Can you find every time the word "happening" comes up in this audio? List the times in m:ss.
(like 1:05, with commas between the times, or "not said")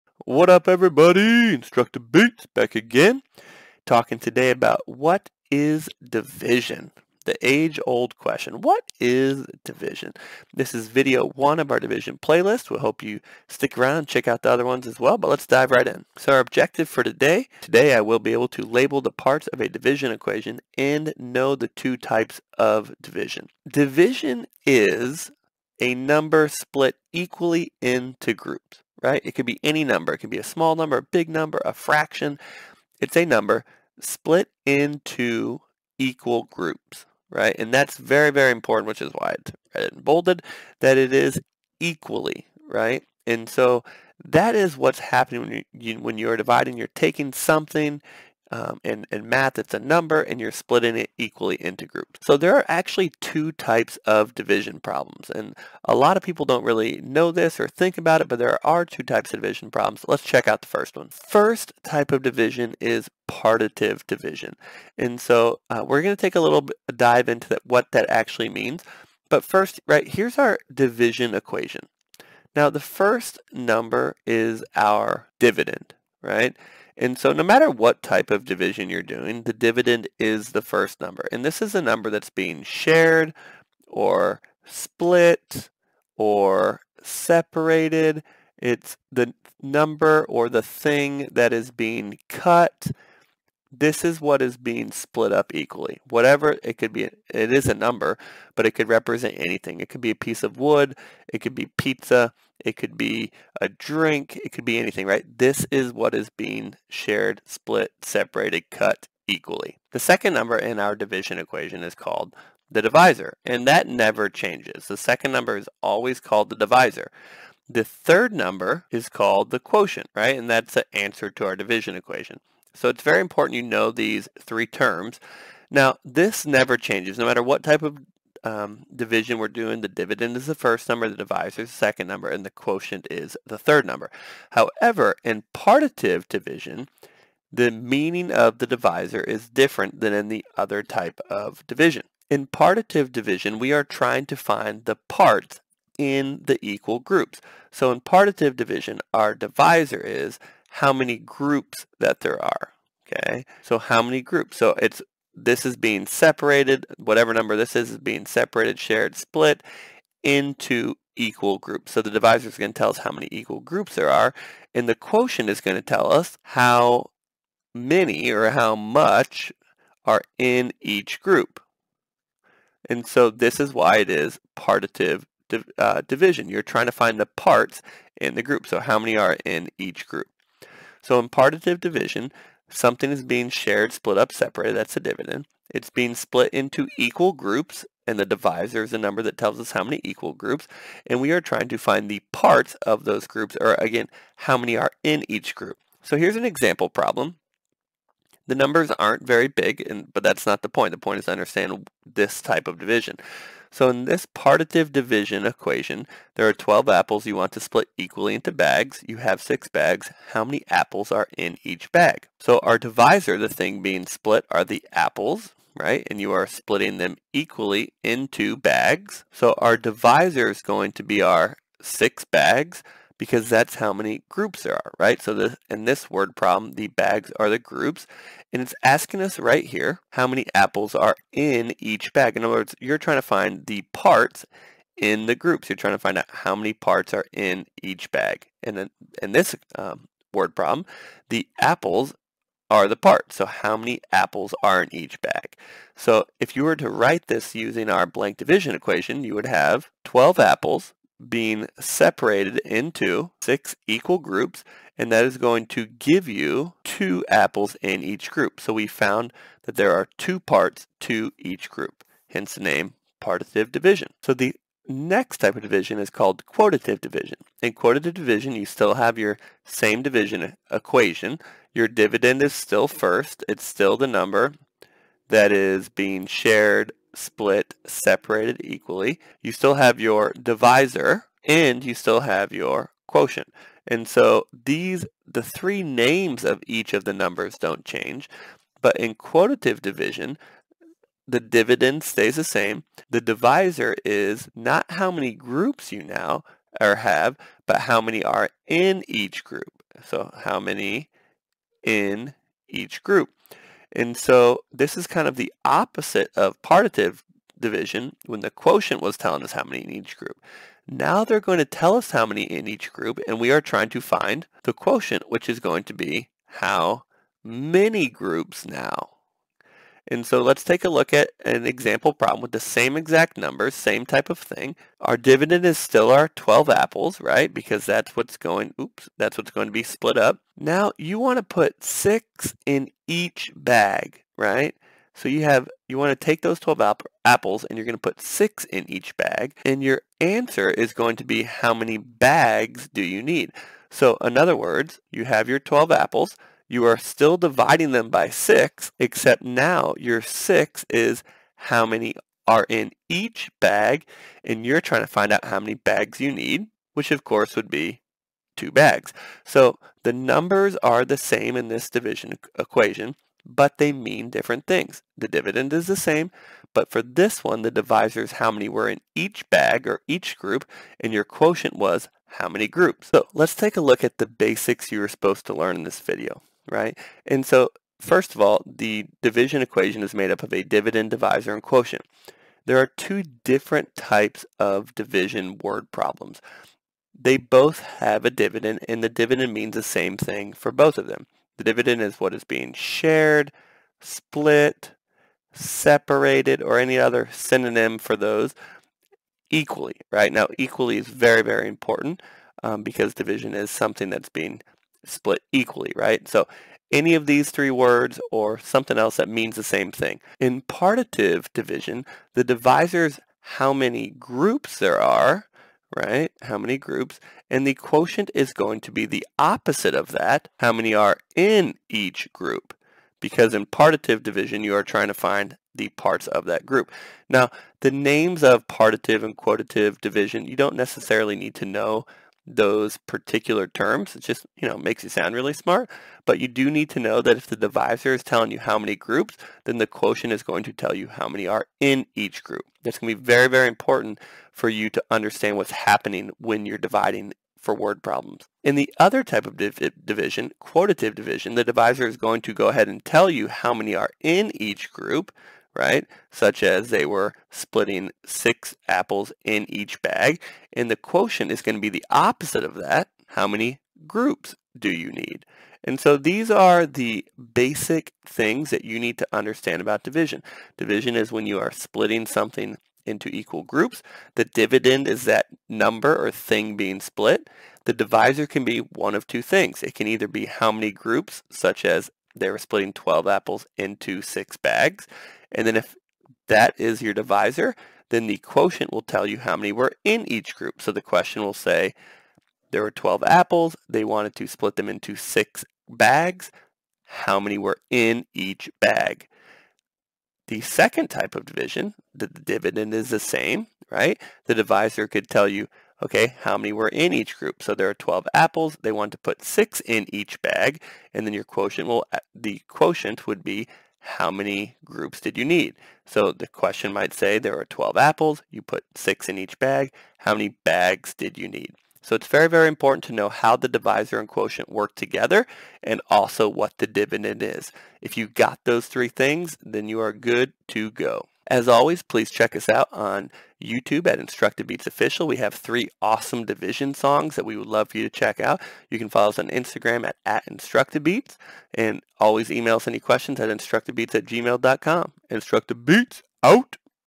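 0:44, 7:25.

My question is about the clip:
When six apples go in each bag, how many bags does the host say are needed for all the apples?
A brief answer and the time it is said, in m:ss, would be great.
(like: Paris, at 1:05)
2, at 5:58.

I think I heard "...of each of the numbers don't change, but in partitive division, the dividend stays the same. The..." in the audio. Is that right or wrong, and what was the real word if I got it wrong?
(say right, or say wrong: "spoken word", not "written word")
wrong: "quotative", not "partitive".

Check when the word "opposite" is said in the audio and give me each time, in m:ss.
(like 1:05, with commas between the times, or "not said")
5:05, 6:59, 7:42.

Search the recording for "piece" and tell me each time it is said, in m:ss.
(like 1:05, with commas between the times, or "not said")
1:40.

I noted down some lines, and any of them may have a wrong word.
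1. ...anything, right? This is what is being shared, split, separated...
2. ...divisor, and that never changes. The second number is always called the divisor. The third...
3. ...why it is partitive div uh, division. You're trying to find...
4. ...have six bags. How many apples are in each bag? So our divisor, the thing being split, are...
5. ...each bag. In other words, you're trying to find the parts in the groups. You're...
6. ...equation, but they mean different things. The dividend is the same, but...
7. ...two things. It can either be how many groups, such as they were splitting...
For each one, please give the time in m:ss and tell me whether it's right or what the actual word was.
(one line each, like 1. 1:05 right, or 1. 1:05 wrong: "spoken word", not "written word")
1. 1:44 right
2. 1:52 right
3. 2:53 right
4. 3:29 right
5. 3:51 right
6. 6:02 right
7. 7:59 right.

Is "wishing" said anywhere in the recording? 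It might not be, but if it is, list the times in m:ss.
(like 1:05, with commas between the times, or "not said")
not said.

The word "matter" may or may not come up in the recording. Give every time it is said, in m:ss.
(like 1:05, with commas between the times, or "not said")
1:17, 2:07.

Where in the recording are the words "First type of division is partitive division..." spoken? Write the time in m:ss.
1:01.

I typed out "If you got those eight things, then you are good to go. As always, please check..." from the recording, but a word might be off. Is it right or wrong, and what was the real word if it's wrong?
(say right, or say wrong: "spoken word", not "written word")
wrong: "three", not "eight".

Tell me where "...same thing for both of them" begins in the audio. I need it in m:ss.
6:29.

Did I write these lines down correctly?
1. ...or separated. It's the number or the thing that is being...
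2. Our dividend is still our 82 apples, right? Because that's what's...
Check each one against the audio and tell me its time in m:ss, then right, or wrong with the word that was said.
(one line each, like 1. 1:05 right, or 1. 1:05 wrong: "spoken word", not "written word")
1. 1:26 right
2. 5:24 wrong: "12", not "82".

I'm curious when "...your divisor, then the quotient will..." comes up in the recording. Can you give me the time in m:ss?
8:07.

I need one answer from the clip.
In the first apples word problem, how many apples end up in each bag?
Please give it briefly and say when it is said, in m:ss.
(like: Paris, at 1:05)
2, at 4:16.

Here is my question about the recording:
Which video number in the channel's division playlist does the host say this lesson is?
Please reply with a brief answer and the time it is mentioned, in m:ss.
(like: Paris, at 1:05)
1, at 0:10.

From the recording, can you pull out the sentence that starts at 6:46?
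So any of these three words or something else that means the same thing.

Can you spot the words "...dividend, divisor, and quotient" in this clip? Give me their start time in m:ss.
6:20.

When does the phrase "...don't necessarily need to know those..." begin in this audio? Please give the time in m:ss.
7:10.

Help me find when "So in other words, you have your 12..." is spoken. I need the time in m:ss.
5:43.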